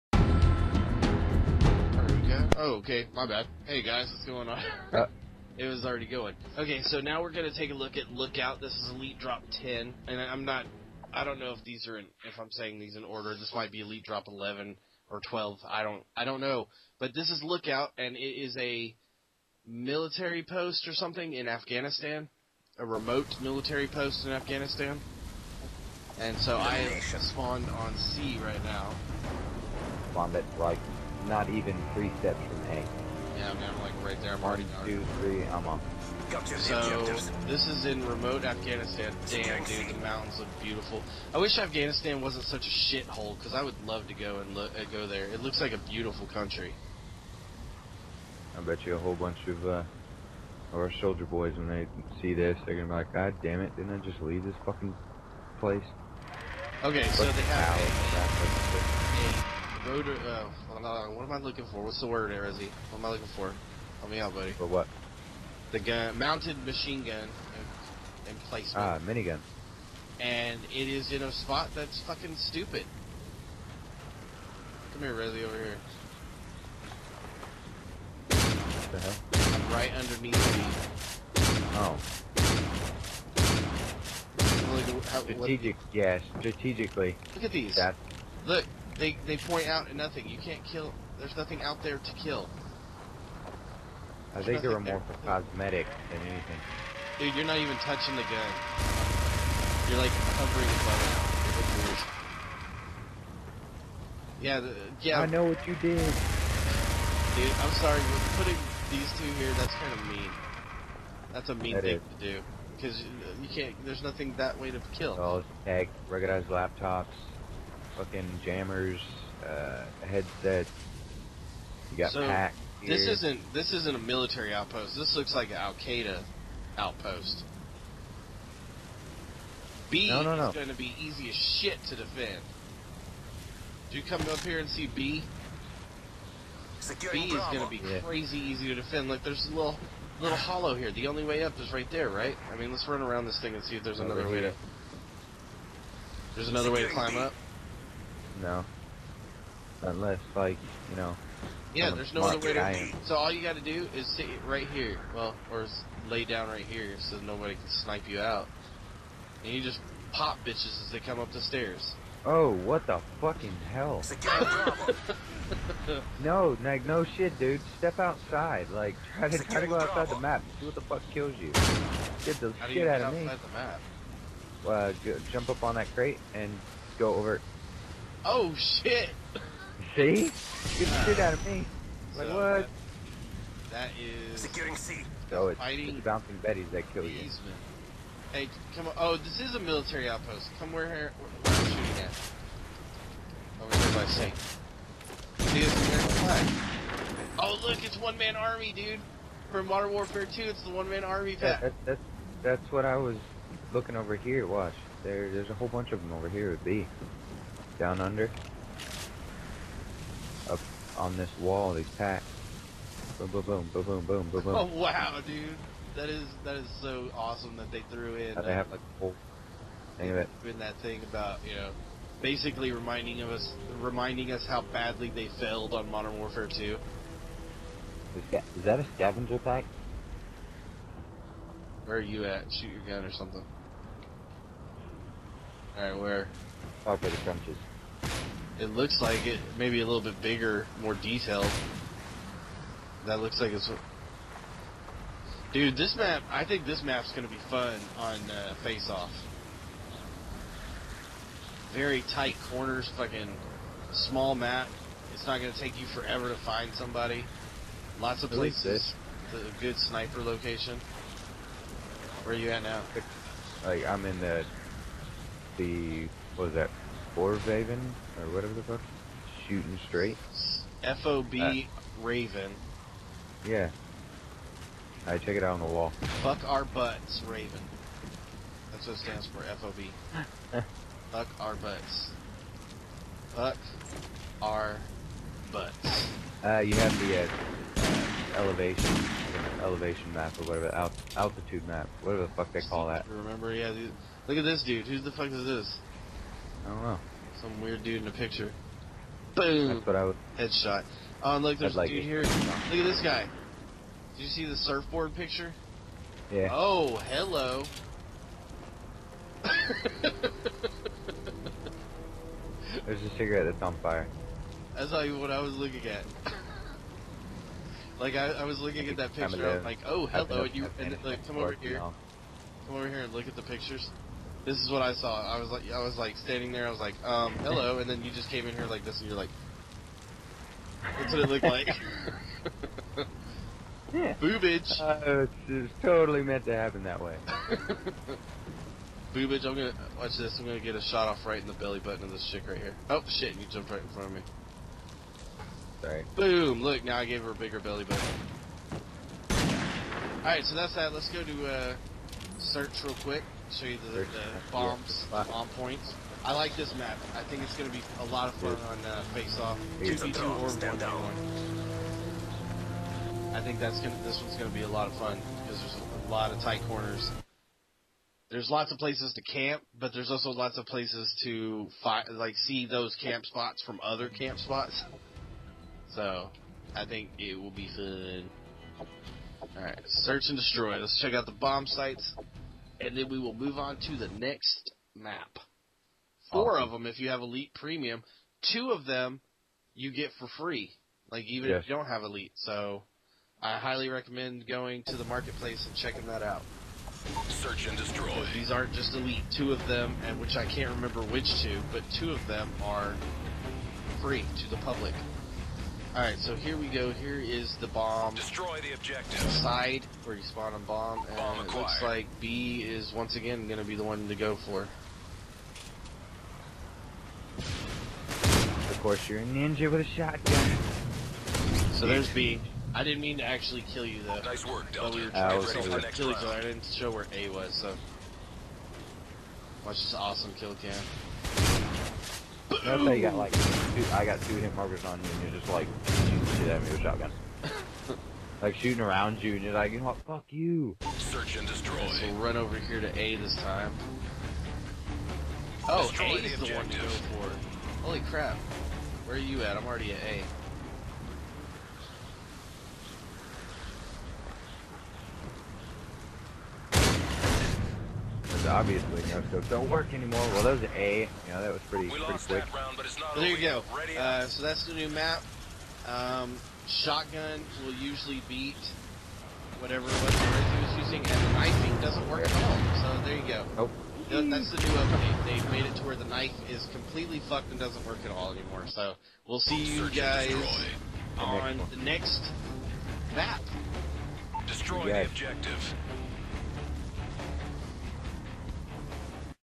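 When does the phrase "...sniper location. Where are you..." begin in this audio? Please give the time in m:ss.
4:19.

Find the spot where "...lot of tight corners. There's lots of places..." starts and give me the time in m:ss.
6:06.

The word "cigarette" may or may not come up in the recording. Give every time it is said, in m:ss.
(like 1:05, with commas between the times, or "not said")
5:13.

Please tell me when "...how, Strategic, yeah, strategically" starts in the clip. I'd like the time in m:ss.
1:25.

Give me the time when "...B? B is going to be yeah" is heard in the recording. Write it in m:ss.
2:14.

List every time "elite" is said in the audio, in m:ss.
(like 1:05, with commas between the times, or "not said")
0:08, 0:13, 6:27, 6:32, 6:38.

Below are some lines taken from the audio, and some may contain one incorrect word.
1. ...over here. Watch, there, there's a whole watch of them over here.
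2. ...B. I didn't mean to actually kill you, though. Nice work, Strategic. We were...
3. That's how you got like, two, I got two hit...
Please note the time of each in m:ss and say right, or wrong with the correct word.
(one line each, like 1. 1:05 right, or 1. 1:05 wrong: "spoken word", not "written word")
1. 3:23 wrong: "bunch", not "watch"
2. 7:02 wrong: "Delta", not "Strategic"
3. 7:12 right.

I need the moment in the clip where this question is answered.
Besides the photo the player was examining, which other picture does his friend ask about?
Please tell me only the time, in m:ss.
5:04.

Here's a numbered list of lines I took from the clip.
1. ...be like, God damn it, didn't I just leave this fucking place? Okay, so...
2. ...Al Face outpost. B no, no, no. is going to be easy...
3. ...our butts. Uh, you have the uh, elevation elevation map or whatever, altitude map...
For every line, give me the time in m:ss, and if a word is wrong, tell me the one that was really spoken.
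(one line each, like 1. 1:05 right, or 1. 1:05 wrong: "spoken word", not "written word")
1. 0:52 right
2. 2:05 wrong: "Qaeda", not "Face"
3. 4:44 right.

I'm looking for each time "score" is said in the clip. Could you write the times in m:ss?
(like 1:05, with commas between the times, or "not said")
not said.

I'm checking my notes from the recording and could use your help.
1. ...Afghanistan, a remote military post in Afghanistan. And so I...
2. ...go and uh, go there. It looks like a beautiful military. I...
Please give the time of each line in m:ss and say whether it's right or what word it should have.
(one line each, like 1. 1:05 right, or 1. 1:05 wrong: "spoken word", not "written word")
1. 0:21 right
2. 0:44 wrong: "country", not "military".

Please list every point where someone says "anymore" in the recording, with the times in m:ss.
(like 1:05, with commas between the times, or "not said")
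7:39, 7:58.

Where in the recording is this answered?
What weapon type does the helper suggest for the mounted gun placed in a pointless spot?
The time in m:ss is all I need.
1:09.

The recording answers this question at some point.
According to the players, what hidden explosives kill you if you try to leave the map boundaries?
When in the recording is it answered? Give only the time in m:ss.
3:06.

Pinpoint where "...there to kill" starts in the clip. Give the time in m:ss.
1:31.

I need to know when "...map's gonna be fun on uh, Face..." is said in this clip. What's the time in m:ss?
4:06.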